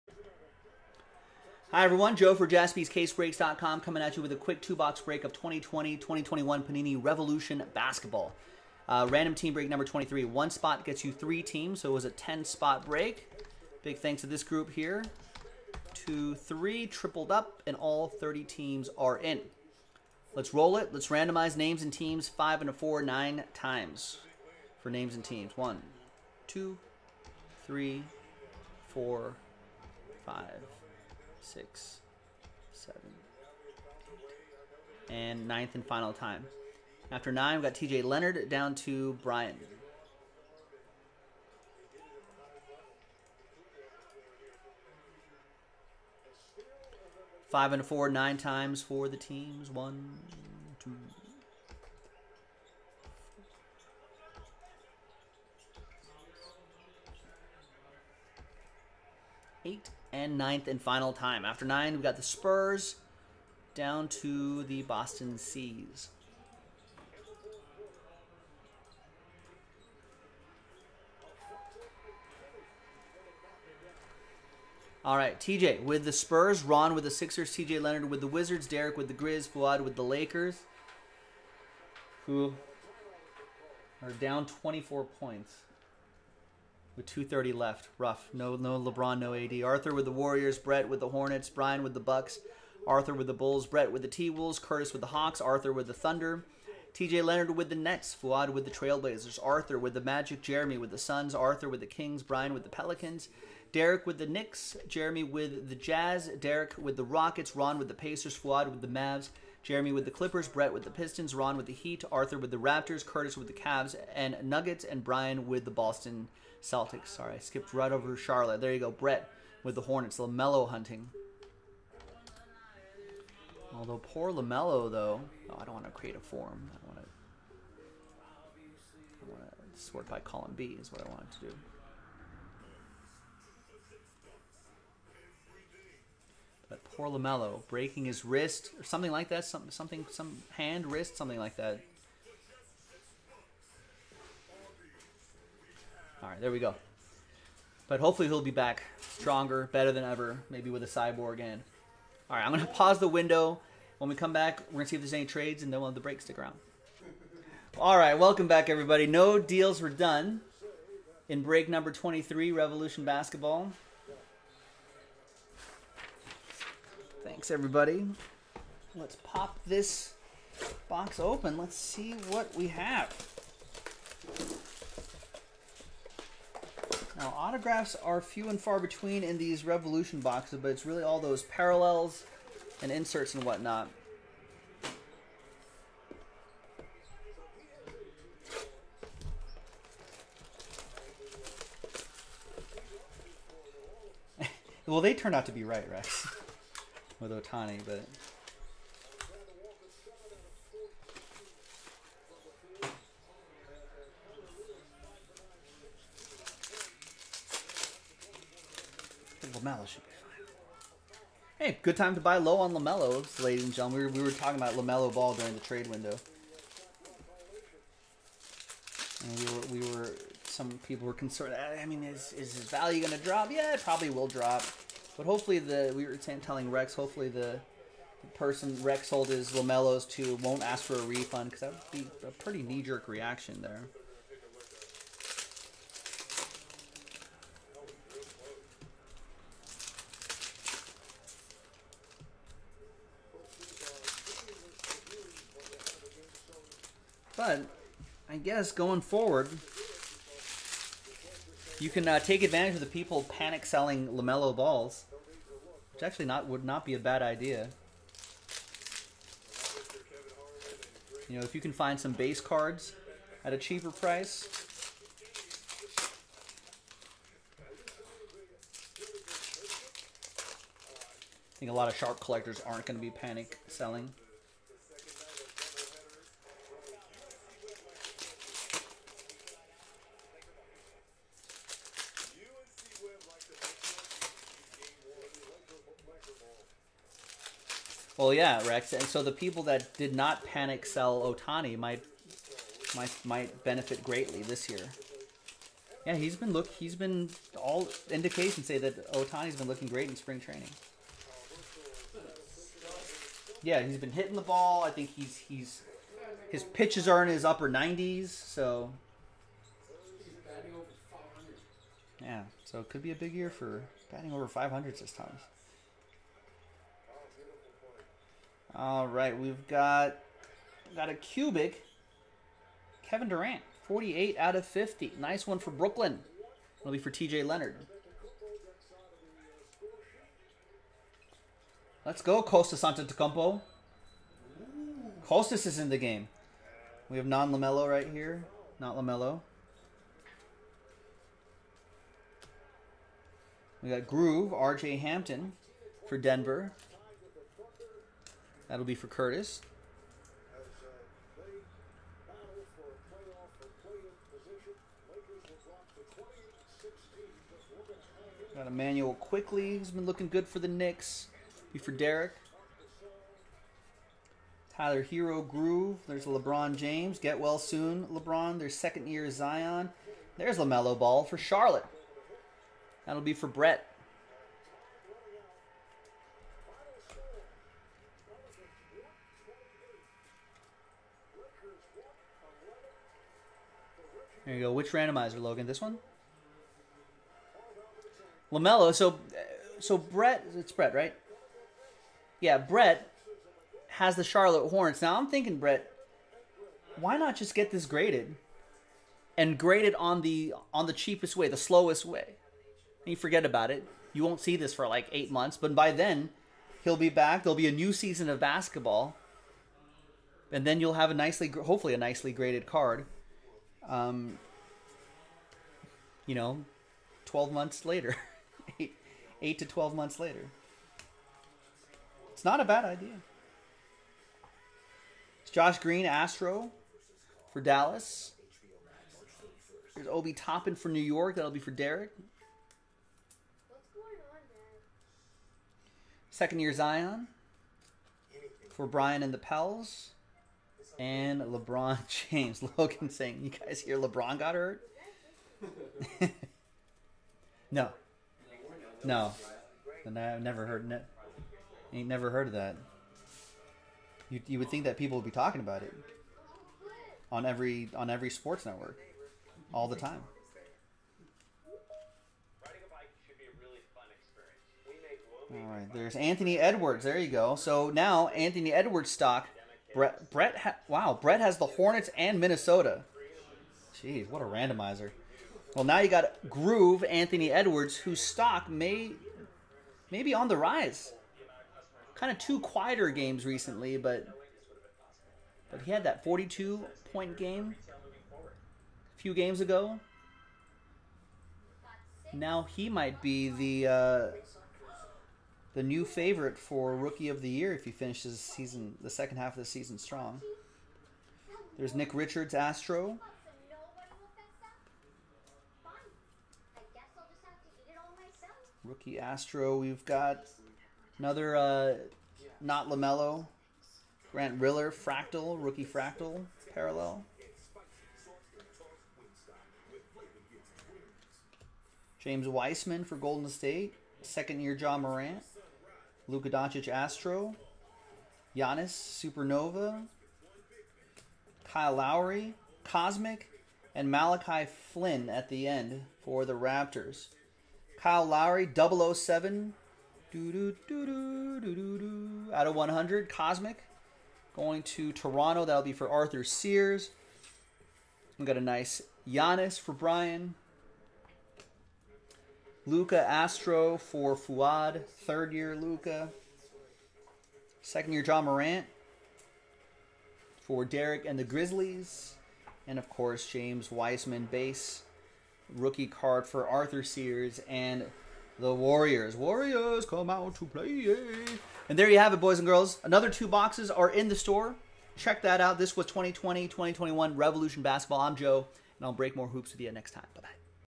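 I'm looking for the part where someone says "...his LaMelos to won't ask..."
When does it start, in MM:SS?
03:49.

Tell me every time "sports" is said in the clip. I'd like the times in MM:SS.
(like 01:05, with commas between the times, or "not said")
07:38.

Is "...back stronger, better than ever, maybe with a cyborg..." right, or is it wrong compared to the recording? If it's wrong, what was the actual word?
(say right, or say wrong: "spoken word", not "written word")
right.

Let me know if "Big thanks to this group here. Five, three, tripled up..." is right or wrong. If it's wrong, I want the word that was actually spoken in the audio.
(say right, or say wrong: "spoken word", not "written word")
wrong: "Two", not "Five".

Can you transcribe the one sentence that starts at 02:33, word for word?
When we come back, we're going to see if there's any trades, and then we'll have the break stick around.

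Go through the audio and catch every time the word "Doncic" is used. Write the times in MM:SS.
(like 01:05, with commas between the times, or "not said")
08:46.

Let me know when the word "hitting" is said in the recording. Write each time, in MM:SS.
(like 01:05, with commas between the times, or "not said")
05:04.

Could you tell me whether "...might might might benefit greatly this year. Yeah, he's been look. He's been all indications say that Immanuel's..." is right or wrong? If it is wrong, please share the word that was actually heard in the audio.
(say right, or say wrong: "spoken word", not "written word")
wrong: "Ohtani", not "Immanuel".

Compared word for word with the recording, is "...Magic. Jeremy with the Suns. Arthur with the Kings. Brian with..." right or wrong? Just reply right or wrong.
right.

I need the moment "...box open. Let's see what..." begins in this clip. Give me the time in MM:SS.
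02:50.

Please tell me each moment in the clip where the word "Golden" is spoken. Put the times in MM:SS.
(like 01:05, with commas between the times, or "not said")
08:43.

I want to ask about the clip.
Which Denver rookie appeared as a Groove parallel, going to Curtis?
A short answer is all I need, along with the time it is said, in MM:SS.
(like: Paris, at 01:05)
RJ Hampton, at 05:44.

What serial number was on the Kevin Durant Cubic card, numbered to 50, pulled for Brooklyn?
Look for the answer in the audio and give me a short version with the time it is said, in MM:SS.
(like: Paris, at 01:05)
48, at 05:23.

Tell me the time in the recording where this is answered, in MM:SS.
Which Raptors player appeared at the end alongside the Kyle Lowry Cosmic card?
08:54.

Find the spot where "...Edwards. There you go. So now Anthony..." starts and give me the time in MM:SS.
07:46.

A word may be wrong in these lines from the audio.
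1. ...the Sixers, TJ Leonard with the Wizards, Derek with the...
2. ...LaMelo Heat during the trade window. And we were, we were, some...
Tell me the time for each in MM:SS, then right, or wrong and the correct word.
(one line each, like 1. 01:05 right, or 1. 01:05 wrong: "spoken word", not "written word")
1. 01:17 right
2. 03:34 wrong: "Ball", not "Heat".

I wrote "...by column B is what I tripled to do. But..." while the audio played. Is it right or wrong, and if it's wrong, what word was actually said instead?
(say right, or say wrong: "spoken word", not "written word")
wrong: "wanted", not "tripled".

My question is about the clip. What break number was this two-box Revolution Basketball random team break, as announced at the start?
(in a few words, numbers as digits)
23.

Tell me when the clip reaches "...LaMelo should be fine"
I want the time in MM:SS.
03:29.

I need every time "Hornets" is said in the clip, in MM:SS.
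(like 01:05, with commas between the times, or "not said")
01:31, 01:59, 06:34, 07:51.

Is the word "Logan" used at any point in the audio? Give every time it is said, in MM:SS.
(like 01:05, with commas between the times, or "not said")
06:25, 07:22.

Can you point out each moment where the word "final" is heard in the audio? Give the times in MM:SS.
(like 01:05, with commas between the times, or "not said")
00:35, 01:00.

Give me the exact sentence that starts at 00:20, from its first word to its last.
Let's randomize names and teams five and a four nine times for names and teams.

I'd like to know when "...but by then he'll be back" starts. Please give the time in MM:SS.
06:45.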